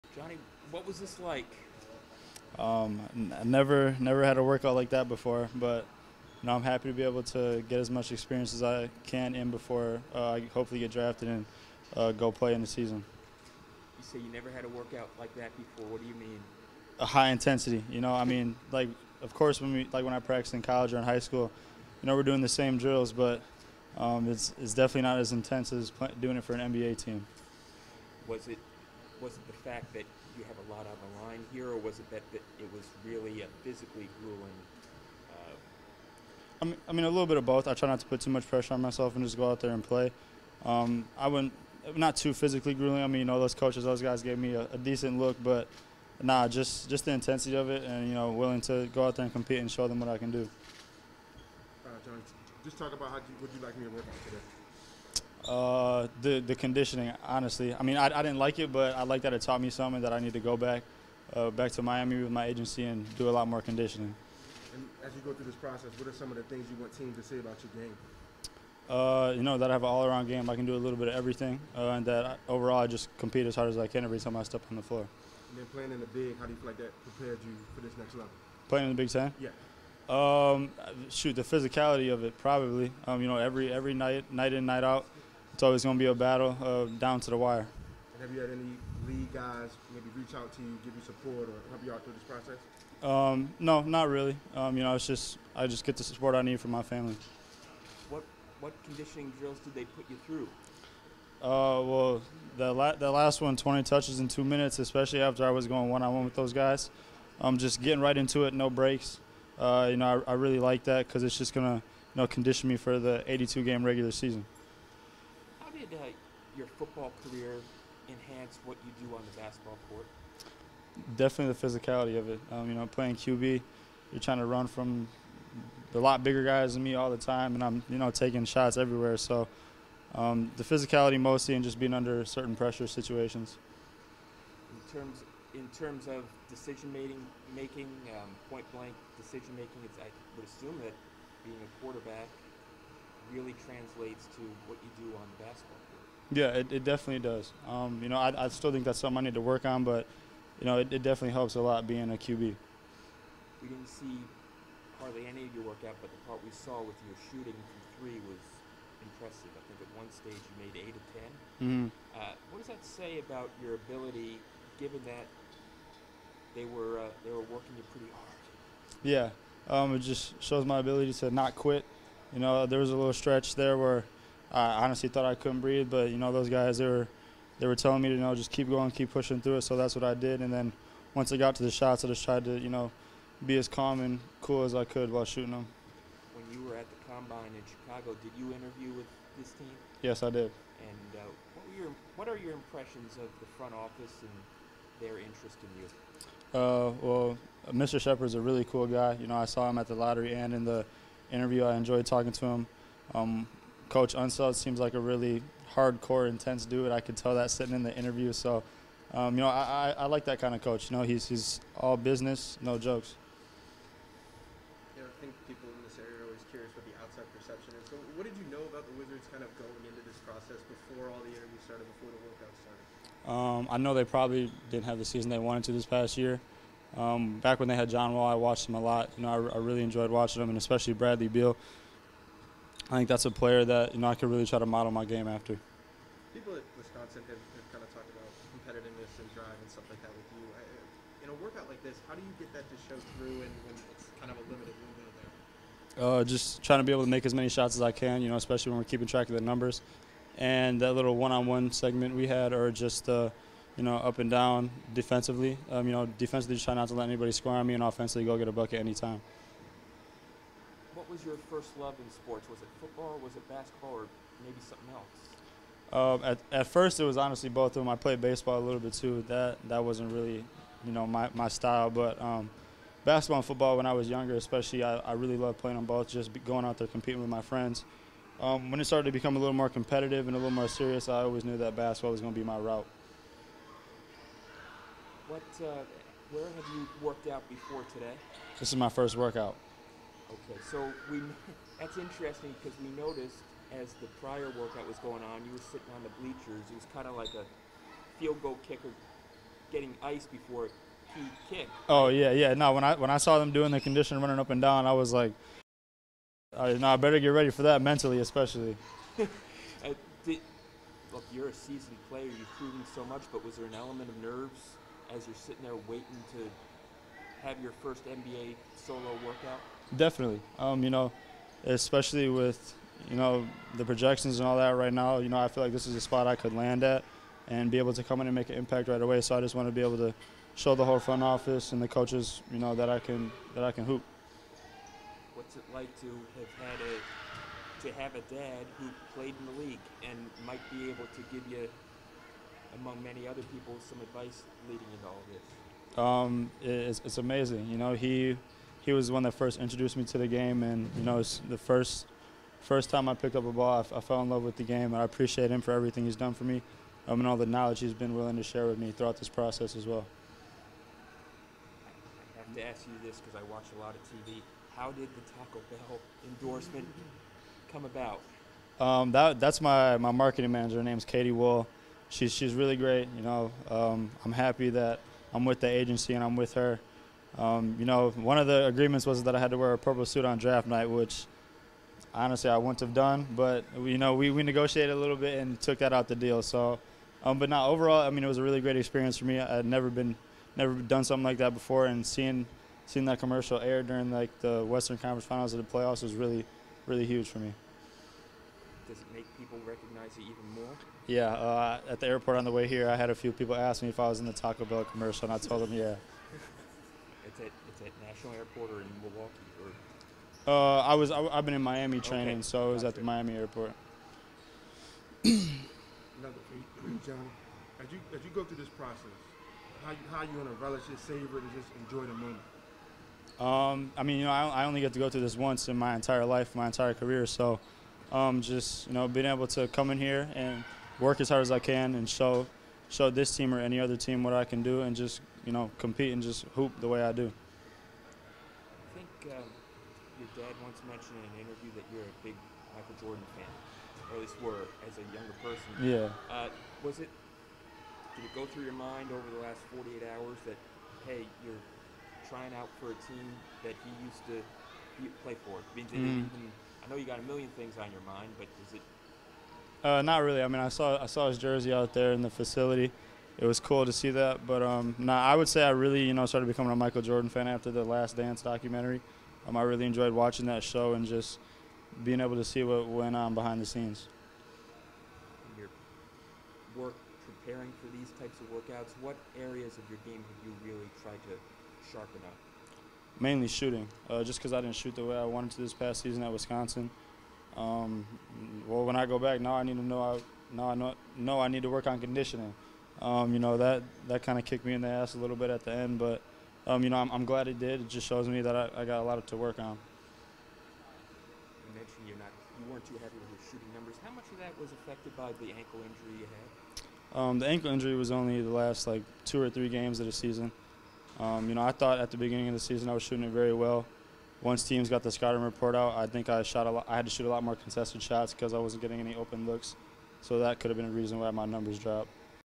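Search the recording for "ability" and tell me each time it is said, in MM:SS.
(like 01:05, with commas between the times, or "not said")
02:43, 02:50.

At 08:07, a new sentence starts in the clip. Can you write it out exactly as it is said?
Um, well, when I go back now, I need to know I now I know, know I need to work on conditioning.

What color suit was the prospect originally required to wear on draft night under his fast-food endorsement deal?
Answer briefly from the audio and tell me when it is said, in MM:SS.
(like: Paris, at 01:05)
purple, at 06:19.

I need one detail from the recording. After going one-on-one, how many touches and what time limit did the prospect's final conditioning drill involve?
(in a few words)
20 touches in two minutes.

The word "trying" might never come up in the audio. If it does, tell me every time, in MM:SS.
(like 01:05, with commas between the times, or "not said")
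02:04, 04:06, 07:32.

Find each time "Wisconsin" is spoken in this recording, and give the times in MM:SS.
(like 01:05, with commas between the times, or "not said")
03:56, 08:06.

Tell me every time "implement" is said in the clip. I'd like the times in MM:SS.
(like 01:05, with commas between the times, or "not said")
not said.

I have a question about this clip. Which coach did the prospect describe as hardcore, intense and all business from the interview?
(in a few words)
Coach Unseld.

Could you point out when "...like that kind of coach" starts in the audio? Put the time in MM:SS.
03:30.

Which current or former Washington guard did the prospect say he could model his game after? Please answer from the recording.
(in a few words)
Bradley Beal.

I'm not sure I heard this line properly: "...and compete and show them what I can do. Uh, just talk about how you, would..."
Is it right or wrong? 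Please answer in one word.
right.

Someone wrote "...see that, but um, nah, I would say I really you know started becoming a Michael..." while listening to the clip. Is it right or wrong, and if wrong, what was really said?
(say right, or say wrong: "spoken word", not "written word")
right.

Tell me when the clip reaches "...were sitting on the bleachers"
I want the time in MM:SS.
04:55.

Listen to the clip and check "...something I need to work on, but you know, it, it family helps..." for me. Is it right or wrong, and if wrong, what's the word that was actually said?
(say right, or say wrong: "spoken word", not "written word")
wrong: "definitely", not "family".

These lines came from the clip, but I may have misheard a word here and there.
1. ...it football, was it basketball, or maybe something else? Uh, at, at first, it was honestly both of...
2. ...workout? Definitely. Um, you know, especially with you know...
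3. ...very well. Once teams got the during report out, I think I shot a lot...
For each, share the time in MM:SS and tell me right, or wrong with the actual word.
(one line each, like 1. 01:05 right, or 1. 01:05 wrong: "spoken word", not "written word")
1. 04:22 right
2. 05:19 right
3. 08:33 wrong: "scouting", not "during".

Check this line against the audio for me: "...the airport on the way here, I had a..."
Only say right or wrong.
right.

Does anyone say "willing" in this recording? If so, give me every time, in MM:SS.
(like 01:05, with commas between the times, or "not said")
00:48, 05:58.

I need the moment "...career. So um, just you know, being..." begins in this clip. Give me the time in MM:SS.
07:06.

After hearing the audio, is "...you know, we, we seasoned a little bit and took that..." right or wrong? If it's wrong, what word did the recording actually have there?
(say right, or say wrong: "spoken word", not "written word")
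wrong: "negotiated", not "seasoned".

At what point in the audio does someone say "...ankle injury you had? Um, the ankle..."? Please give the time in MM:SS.
08:25.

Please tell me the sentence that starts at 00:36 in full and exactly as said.
Uh, I, mean, a little bit of both.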